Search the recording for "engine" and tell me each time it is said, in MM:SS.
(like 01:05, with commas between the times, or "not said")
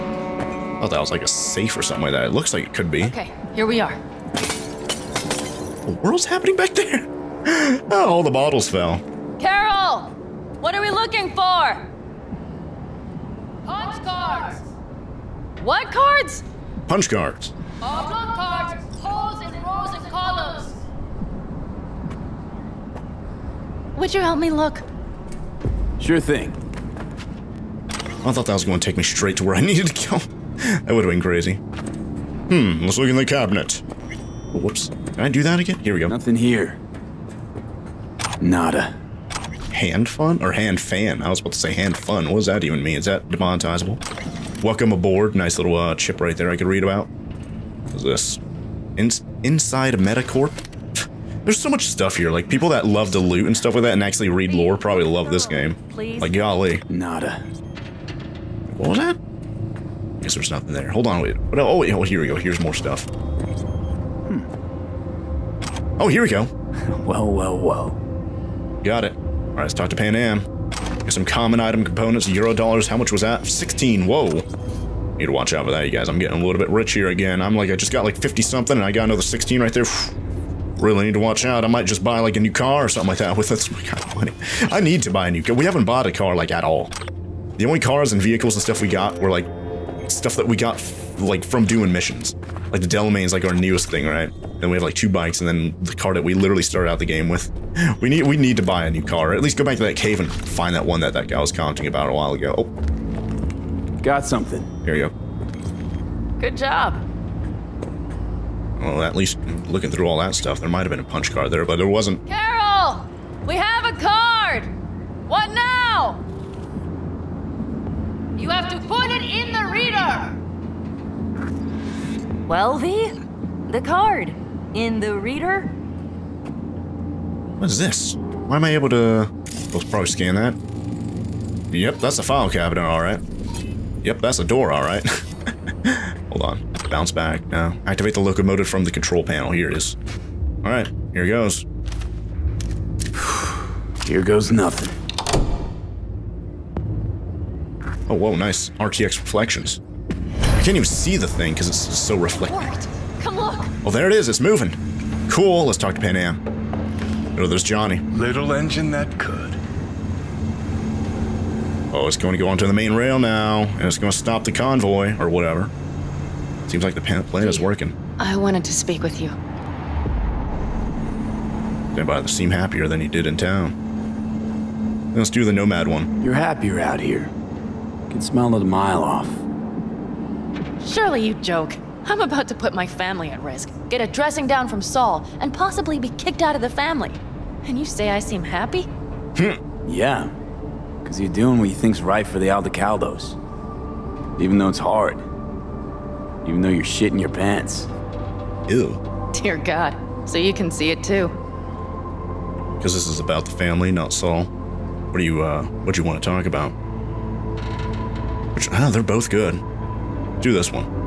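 02:38.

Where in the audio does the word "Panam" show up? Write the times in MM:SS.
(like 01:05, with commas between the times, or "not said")
01:09, 02:35.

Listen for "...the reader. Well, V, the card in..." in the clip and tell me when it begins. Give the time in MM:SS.
01:59.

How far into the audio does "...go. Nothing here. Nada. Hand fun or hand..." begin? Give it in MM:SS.
00:35.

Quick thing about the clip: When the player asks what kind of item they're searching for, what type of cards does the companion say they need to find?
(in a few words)
Punch cards.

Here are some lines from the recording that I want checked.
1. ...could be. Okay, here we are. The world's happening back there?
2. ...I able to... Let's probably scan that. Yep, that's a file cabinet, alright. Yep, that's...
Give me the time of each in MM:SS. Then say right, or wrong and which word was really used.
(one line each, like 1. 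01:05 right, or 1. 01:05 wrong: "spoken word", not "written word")
1. 00:02 right
2. 02:08 right.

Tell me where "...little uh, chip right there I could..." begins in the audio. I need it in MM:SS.
00:45.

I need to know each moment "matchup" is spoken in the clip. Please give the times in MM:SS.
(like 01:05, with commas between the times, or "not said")
not said.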